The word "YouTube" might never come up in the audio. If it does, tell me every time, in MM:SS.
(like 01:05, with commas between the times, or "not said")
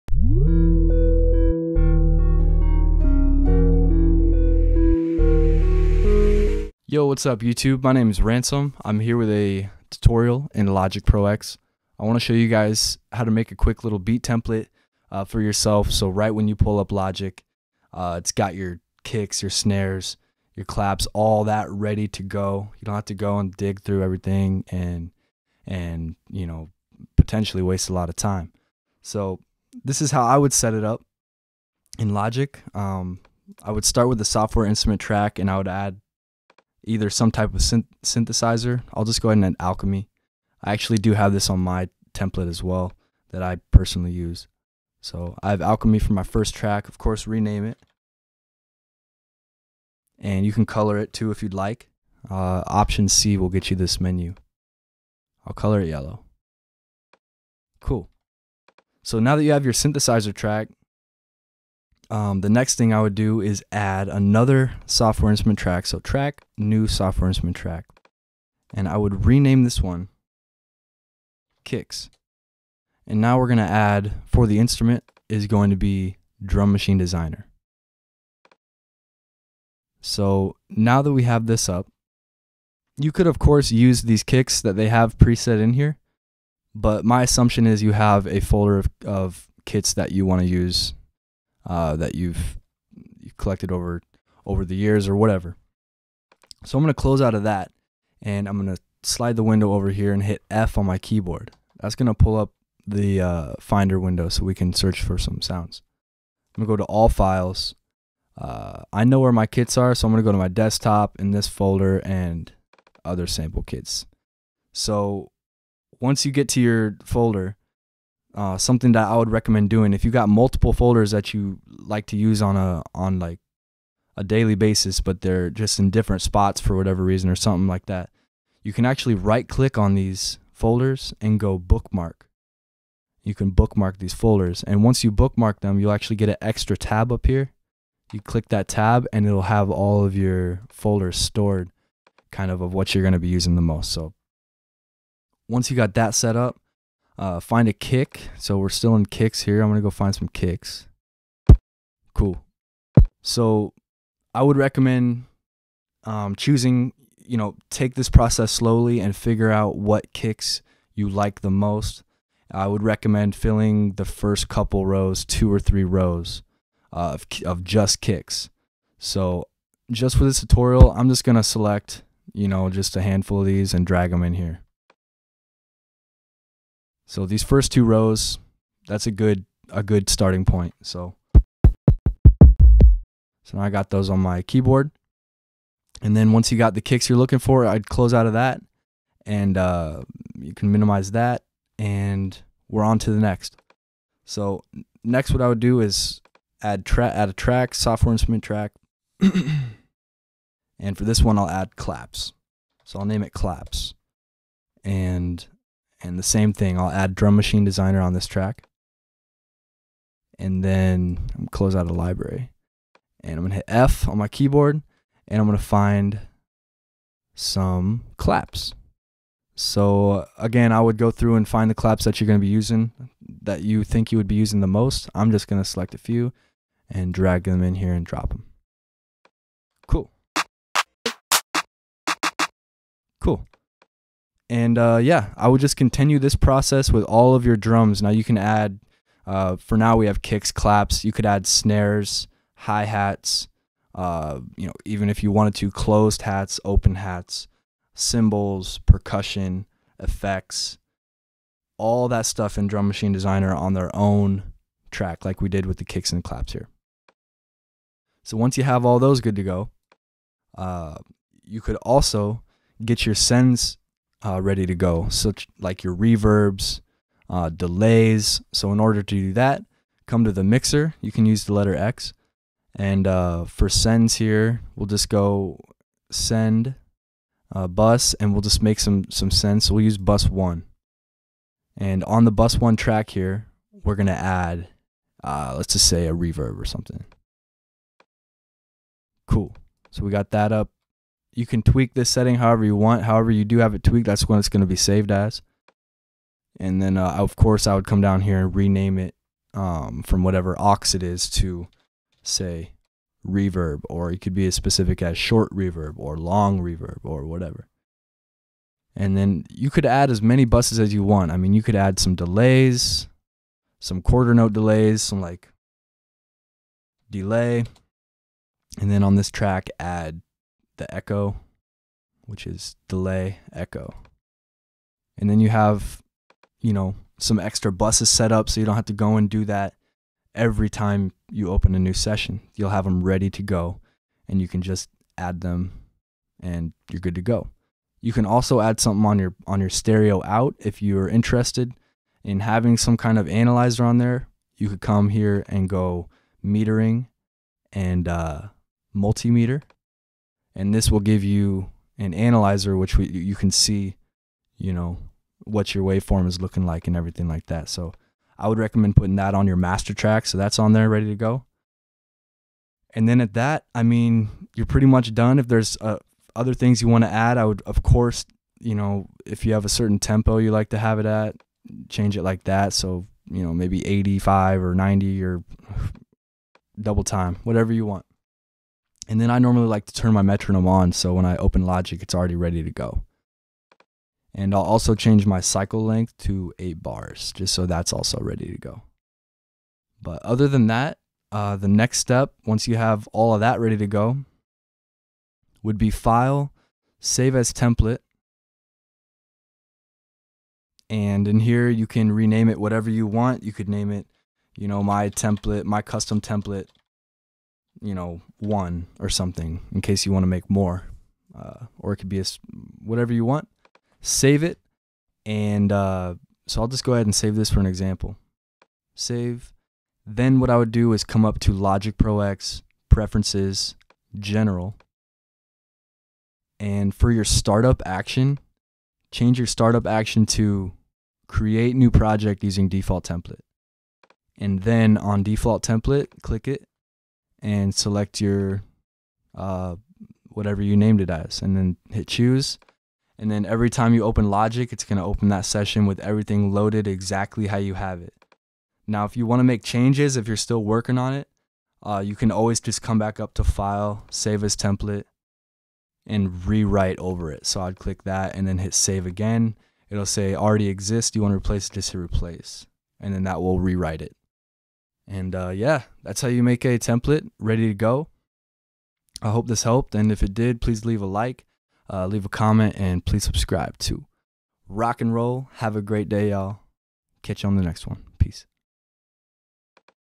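00:07.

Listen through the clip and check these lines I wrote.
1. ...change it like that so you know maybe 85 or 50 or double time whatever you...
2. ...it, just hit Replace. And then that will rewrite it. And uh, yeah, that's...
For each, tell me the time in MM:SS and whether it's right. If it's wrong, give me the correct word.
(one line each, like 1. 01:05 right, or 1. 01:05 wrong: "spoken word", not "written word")
1. 06:11 wrong: "90", not "50"
2. 07:41 right.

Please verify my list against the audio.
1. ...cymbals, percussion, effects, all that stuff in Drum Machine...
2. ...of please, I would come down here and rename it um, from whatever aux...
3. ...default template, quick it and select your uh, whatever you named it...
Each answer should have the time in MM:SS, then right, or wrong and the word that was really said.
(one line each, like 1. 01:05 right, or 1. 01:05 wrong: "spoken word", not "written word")
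1. 04:07 right
2. 04:57 wrong: "course", not "please"
3. 07:15 wrong: "click", not "quick".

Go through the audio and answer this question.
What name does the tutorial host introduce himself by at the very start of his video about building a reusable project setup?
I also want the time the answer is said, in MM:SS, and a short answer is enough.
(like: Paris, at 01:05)
Ransom, at 00:08.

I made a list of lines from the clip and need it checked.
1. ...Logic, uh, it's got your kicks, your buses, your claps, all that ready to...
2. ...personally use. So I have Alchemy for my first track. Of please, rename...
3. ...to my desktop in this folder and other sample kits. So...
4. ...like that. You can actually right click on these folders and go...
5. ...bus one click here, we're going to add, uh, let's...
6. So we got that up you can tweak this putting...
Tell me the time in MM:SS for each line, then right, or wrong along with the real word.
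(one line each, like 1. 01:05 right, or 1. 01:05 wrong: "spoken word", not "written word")
1. 00:16 wrong: "snares", not "buses"
2. 00:43 wrong: "course", not "please"
3. 01:50 right
4. 02:07 right
5. 04:42 wrong: "track", not "click"
6. 04:49 wrong: "setting", not "putting".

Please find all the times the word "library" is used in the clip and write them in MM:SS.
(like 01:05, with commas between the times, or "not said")
03:31.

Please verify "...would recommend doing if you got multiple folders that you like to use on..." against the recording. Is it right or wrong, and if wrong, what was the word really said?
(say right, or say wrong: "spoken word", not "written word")
right.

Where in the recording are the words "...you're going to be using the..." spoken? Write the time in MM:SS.
02:22.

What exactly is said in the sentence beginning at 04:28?
So in order to do that, come to the mixer.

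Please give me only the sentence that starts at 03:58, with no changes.
Now you can add, uh, for now we have kicks, claps.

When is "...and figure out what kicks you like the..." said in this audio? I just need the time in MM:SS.
02:38.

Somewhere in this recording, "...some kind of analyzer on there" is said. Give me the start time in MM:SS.
05:42.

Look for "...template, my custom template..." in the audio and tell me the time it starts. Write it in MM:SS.
06:45.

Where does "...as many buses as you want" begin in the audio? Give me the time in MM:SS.
05:10.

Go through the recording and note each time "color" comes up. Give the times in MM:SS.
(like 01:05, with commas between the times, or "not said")
00:50, 00:55.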